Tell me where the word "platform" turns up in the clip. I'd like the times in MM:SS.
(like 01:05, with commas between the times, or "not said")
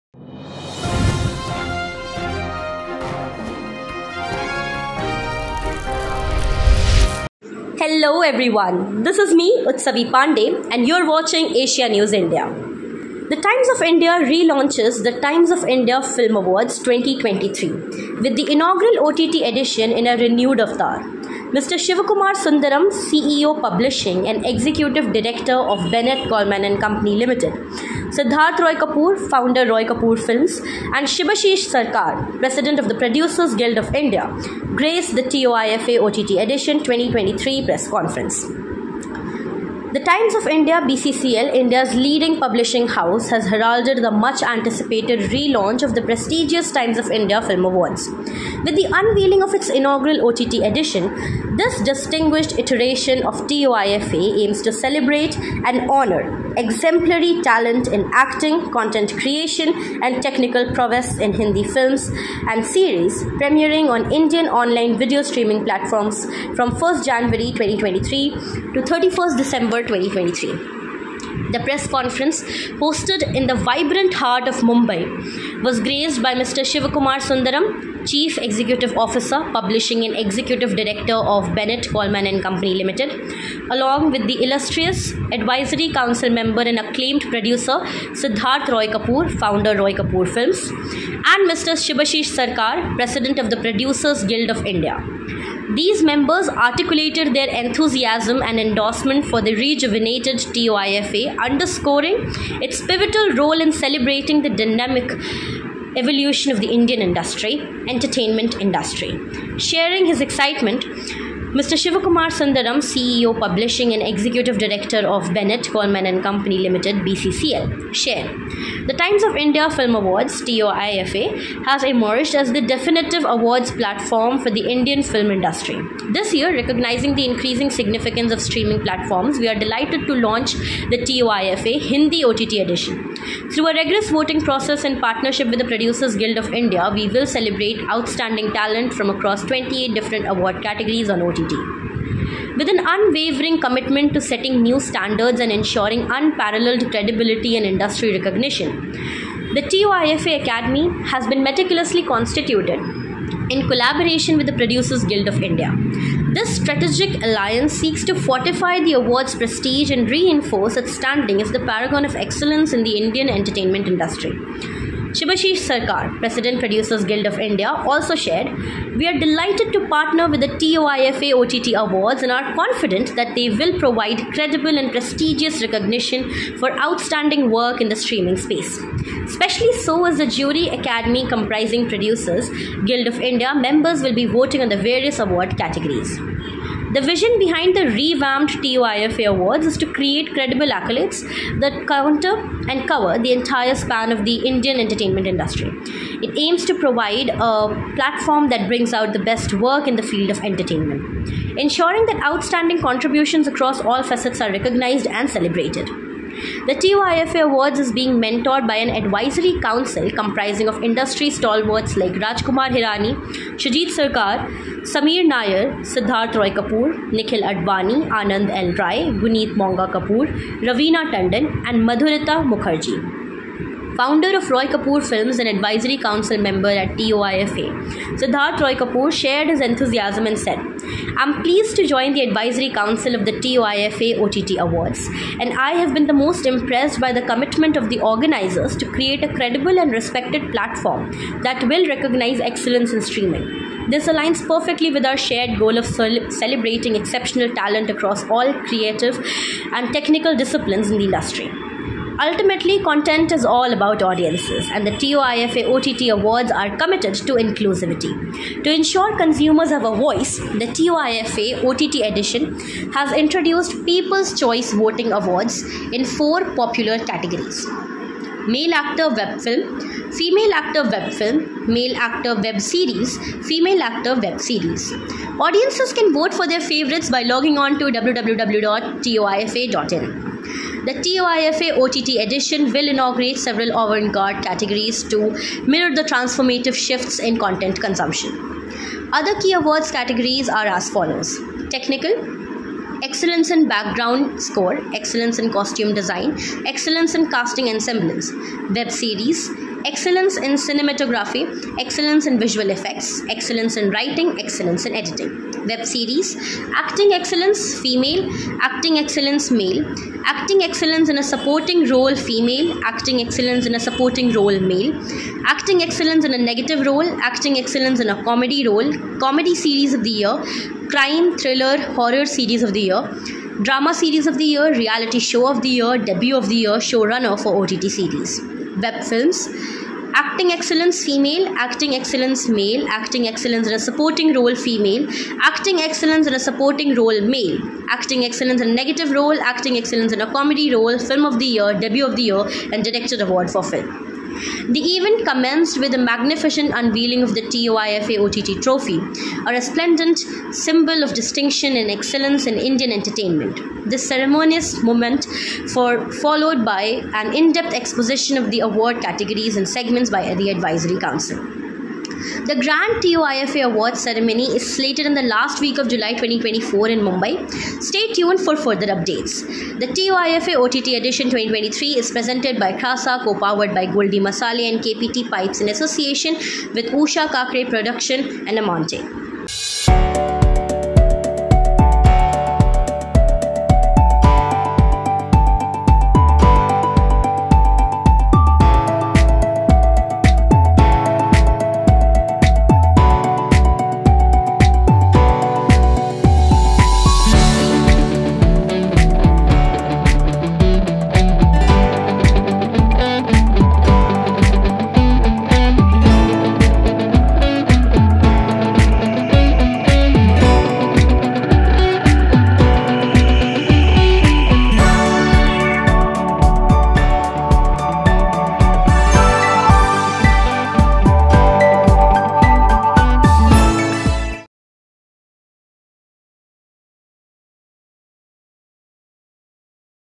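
01:05, 02:03, 02:08, 03:17, 04:00.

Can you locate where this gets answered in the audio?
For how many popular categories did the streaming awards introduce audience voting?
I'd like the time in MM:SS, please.
04:26.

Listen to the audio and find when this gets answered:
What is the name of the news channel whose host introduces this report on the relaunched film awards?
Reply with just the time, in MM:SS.
00:11.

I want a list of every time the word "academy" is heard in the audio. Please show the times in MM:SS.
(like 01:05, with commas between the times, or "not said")
02:30, 03:00.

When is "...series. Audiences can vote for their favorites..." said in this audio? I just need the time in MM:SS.
04:34.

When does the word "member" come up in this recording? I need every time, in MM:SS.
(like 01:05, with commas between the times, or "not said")
01:26, 01:36, 03:03, 03:46.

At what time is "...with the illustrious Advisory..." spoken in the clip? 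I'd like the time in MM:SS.
01:24.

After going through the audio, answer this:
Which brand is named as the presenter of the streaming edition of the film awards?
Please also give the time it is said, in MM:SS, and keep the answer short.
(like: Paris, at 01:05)
Krasa, at 06:12.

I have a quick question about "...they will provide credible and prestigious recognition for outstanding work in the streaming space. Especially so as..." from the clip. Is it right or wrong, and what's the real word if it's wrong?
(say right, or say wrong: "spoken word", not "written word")
right.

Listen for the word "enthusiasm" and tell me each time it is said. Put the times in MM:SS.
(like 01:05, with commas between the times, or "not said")
01:37, 03:49.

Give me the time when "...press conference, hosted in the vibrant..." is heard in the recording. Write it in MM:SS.
01:11.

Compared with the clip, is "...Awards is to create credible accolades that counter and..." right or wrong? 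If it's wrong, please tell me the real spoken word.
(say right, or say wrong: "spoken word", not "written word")
right.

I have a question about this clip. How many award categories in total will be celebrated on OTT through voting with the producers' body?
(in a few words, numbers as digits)
28.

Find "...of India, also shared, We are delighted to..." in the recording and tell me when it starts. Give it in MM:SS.
02:47.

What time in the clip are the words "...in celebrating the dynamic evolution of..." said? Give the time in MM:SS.
01:43.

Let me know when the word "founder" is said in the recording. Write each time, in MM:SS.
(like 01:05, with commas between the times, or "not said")
00:29, 01:29, 03:43.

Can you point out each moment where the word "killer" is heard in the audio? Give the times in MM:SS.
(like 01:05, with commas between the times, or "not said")
not said.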